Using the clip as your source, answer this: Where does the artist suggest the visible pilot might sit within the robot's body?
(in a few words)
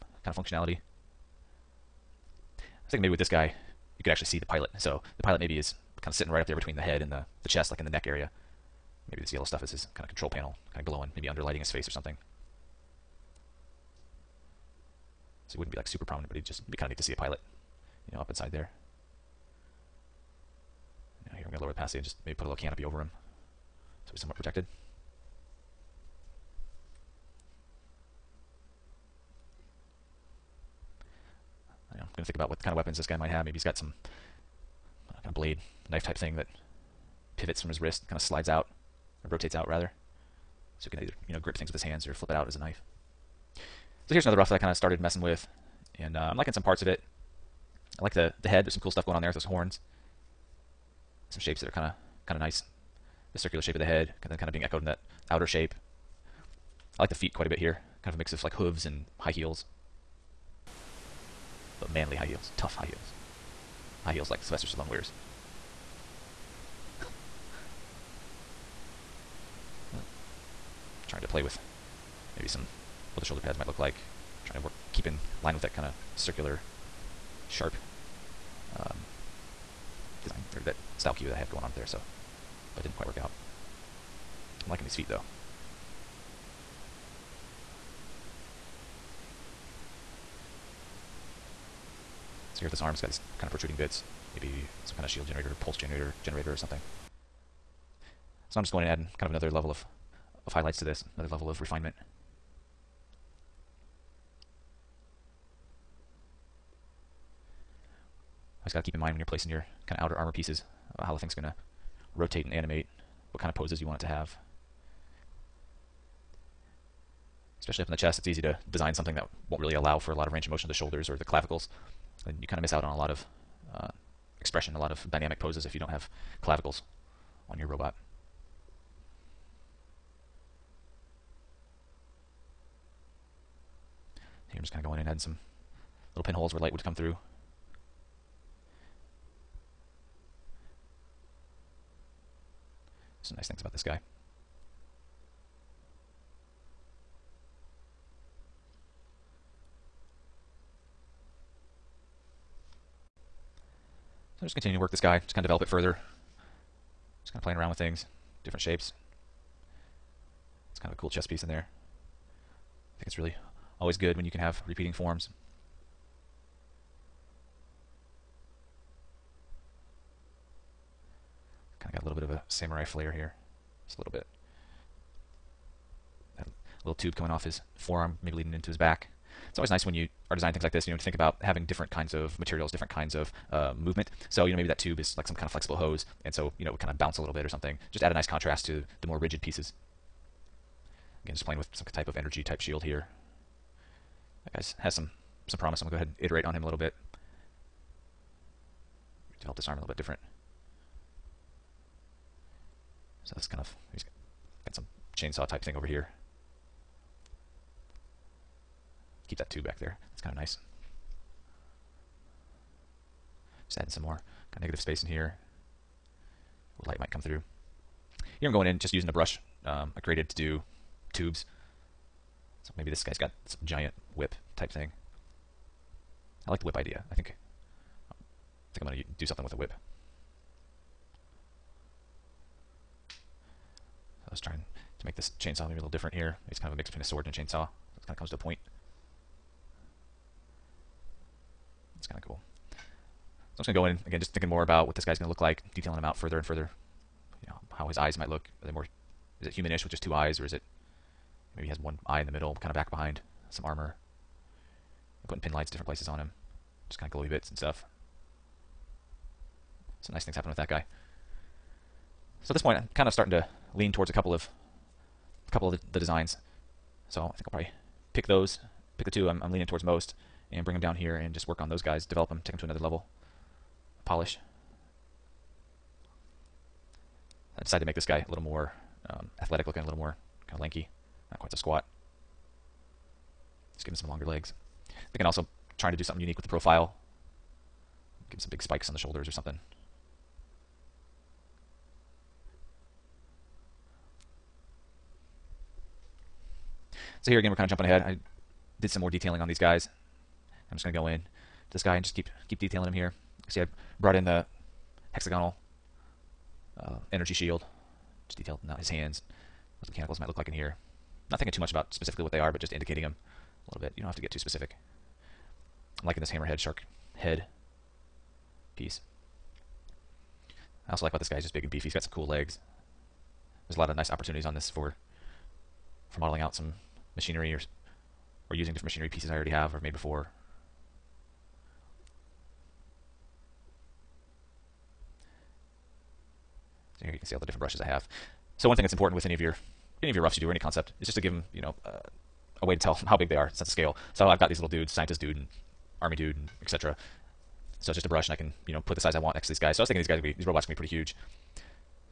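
The neck area.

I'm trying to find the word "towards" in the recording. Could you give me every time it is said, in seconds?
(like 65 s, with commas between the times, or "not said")
263 s, 269 s.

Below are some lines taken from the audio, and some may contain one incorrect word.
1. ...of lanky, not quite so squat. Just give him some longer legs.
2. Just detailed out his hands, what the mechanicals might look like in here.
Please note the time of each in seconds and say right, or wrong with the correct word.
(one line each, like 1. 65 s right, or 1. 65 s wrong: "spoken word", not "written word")
1. 280 s right
2. 308 s right.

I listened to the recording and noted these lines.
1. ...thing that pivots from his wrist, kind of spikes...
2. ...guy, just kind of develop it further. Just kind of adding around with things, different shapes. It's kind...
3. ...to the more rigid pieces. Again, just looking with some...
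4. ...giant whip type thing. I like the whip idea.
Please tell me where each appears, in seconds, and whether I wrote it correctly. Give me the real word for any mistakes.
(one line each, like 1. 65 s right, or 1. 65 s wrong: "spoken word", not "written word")
1. 36 s wrong: "slides", not "spikes"
2. 154 s wrong: "playing", not "adding"
3. 188 s wrong: "playing", not "looking"
4. 223 s right.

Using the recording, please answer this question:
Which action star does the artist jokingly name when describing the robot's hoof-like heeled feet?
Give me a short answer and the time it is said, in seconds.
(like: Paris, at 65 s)
Sylvester Stallone, at 64 s.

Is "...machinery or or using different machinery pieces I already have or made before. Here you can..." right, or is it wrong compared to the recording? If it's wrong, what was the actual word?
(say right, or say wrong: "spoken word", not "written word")
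right.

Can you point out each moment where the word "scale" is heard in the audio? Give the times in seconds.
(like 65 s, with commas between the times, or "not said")
343 s.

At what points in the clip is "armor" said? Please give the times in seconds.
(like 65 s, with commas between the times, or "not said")
110 s, 253 s.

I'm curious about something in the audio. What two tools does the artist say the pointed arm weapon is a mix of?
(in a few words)
A sword and a chainsaw.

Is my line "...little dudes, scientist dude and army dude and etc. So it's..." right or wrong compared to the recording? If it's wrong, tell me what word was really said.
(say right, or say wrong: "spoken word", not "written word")
right.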